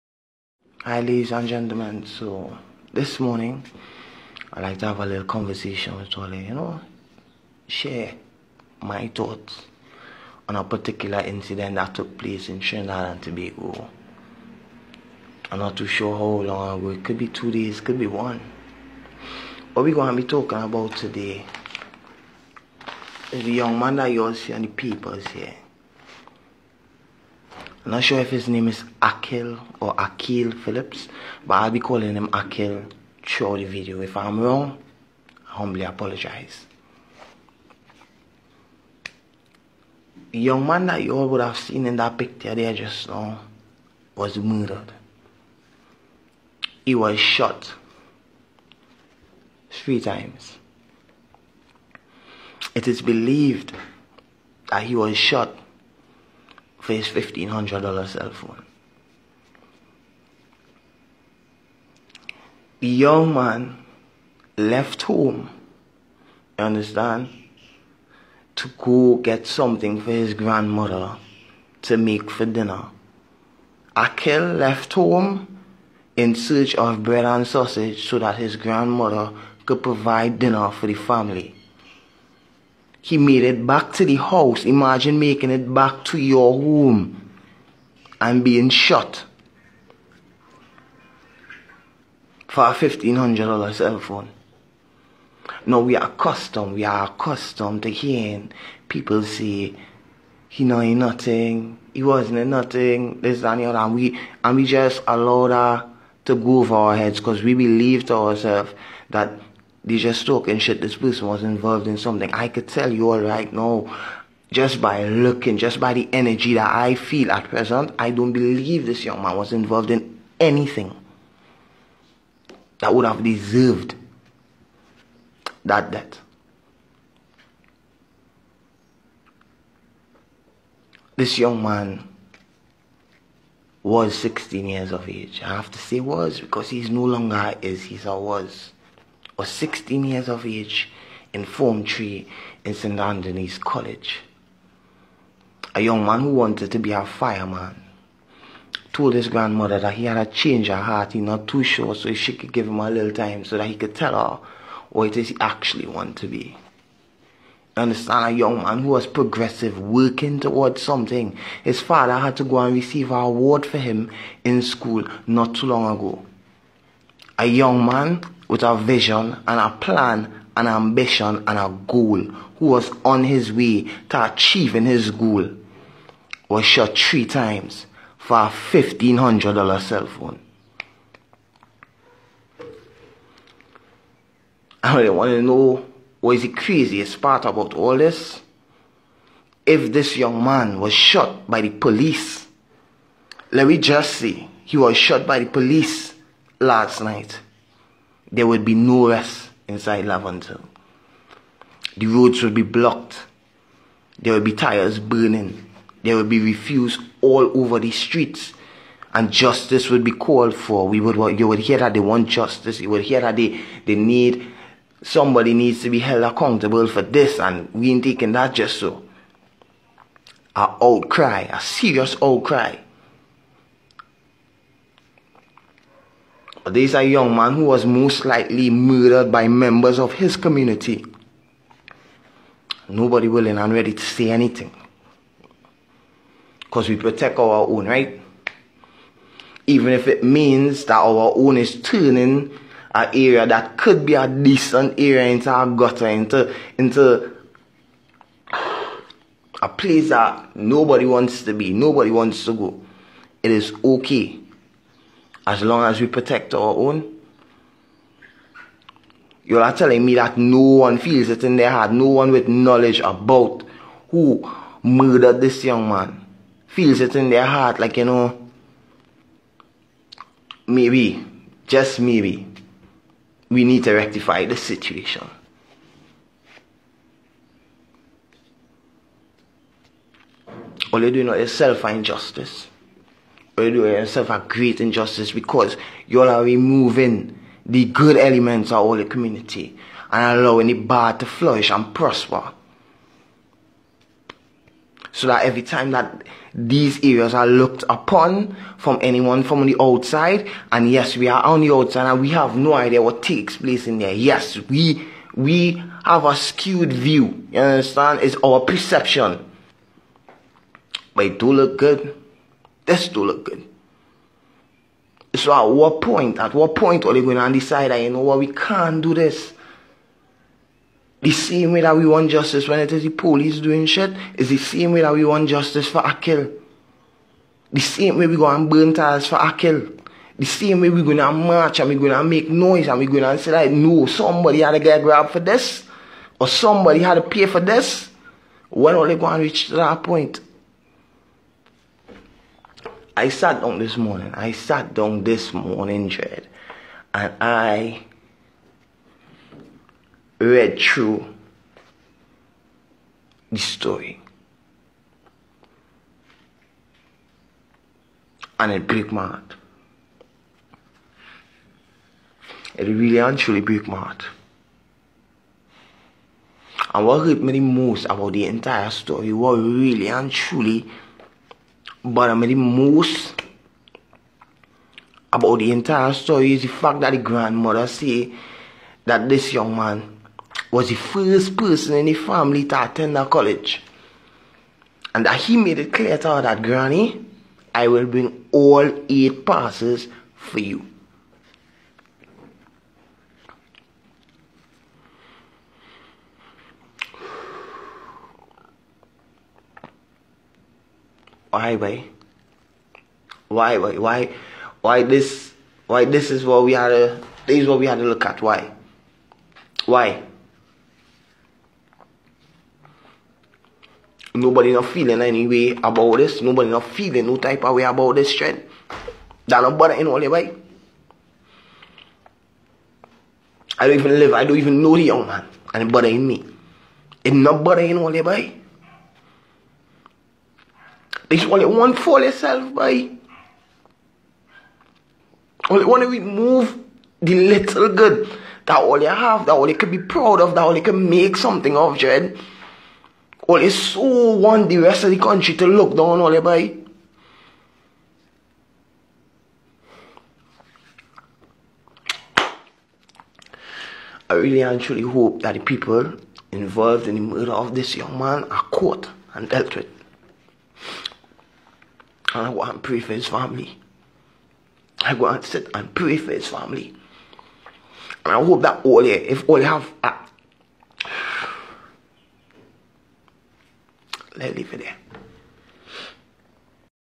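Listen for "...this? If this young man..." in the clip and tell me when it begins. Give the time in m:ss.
3:07.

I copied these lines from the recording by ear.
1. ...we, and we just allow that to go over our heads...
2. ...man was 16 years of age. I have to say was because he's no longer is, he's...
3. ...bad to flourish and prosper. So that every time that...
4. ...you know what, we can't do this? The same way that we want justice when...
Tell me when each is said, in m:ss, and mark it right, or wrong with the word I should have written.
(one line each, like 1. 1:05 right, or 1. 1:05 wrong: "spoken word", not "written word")
1. 1:43 right
2. 2:11 right
3. 4:50 right
4. 5:18 right.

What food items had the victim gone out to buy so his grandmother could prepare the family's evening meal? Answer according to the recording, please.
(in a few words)
Bread and sausage.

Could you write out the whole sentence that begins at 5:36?
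Or somebody had to pay for this.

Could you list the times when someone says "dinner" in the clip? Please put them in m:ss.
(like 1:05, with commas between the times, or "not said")
1:12, 1:20.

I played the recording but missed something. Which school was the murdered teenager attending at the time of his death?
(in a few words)
St. Anthony's College.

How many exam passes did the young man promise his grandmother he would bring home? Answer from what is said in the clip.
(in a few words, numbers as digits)
8.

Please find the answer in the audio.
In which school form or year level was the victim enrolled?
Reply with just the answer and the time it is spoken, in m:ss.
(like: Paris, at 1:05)
Form 3, at 2:21.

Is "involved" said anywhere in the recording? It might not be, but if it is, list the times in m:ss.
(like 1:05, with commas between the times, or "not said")
1:51, 1:59, 7:36.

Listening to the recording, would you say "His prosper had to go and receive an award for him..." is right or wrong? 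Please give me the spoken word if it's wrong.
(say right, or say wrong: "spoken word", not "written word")
wrong: "father", not "prosper".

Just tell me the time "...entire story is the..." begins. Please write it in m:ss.
6:15.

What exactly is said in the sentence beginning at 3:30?
We would, you would hear that they want justice.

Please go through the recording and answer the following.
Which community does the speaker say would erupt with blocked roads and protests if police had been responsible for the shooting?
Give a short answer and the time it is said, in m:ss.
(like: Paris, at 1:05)
Laventille, at 3:20.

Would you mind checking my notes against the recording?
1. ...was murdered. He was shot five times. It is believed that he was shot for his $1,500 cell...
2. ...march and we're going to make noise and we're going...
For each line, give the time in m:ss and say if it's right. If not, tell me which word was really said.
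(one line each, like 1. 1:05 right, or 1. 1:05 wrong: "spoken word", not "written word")
1. 0:44 wrong: "three", not "five"
2. 5:31 right.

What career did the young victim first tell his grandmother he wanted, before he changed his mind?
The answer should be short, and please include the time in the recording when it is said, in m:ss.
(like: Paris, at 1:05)
Fireman, at 2:27.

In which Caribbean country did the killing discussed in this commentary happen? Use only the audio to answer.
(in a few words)
Trinidad and Tobago.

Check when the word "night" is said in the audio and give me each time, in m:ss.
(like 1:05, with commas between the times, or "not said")
3:16.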